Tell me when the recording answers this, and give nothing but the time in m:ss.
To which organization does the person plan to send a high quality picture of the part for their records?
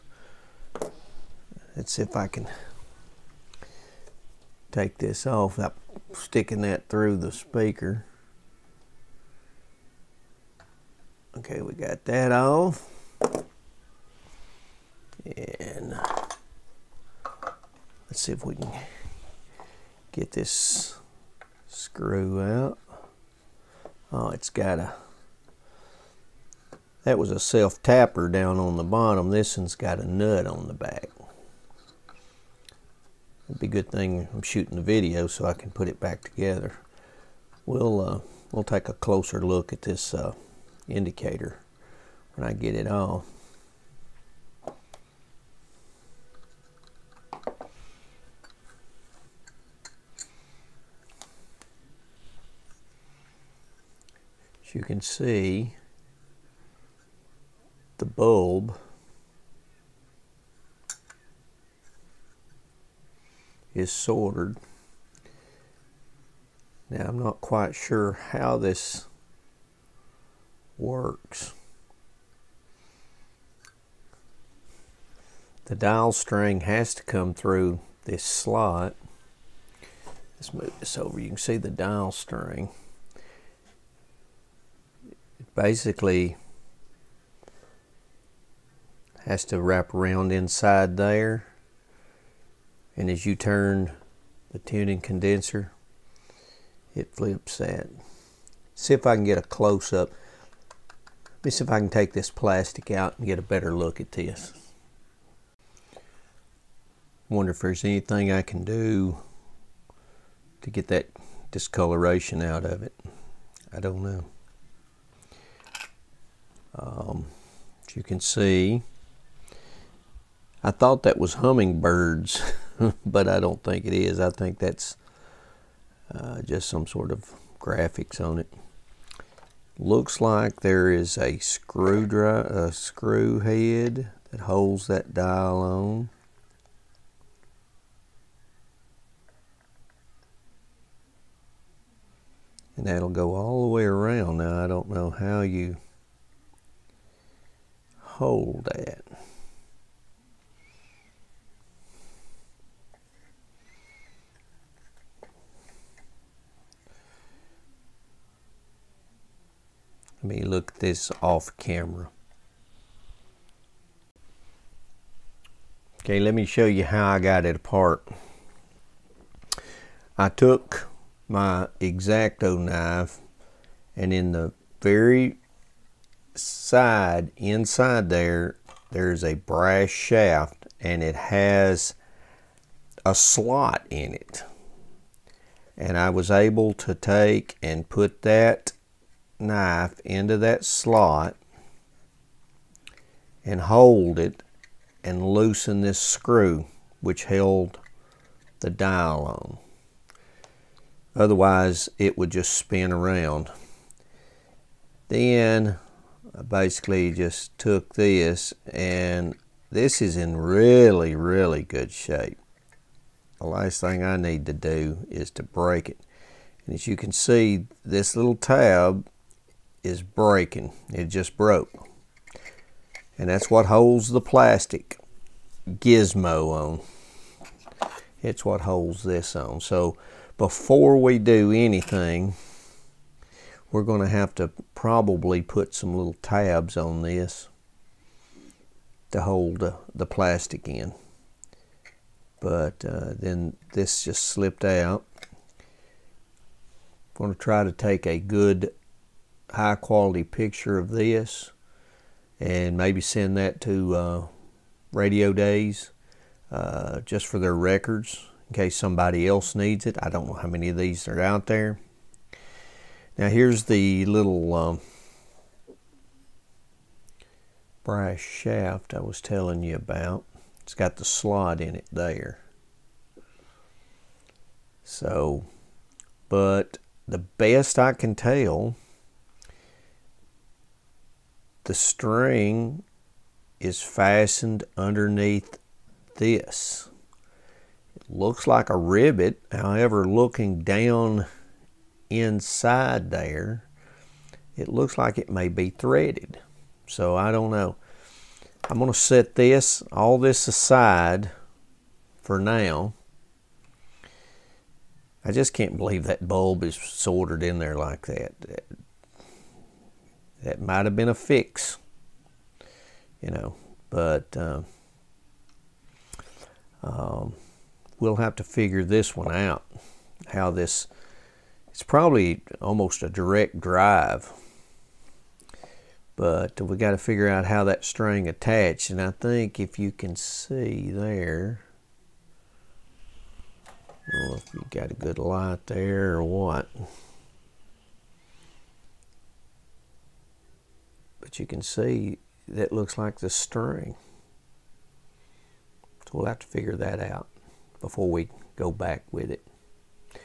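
4:14.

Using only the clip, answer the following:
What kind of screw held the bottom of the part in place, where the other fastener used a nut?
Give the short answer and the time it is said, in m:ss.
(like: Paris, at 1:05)
self-tapper, at 0:27.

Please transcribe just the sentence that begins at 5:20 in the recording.
How this, it's probably almost a direct drive, but we got to figure out how that string attached.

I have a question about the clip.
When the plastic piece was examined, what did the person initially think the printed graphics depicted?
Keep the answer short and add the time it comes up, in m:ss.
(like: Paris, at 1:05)
hummingbirds, at 2:01.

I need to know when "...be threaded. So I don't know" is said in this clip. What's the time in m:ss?
4:55.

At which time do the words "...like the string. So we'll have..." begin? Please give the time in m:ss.
5:42.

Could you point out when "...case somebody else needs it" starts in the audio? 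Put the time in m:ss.
4:18.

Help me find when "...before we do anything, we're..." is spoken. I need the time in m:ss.
3:50.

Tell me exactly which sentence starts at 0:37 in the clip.
We'll, uh, we'll take a closer look at this uh, indicator when I get it off.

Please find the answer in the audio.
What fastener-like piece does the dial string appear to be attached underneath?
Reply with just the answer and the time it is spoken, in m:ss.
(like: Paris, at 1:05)
a rivet, at 4:48.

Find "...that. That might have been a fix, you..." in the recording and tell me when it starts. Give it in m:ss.
5:08.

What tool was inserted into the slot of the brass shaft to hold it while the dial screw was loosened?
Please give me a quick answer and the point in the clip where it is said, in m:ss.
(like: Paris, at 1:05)
X-Acto knife, at 2:51.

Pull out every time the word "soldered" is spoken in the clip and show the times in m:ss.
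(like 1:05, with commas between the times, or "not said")
1:03, 5:06.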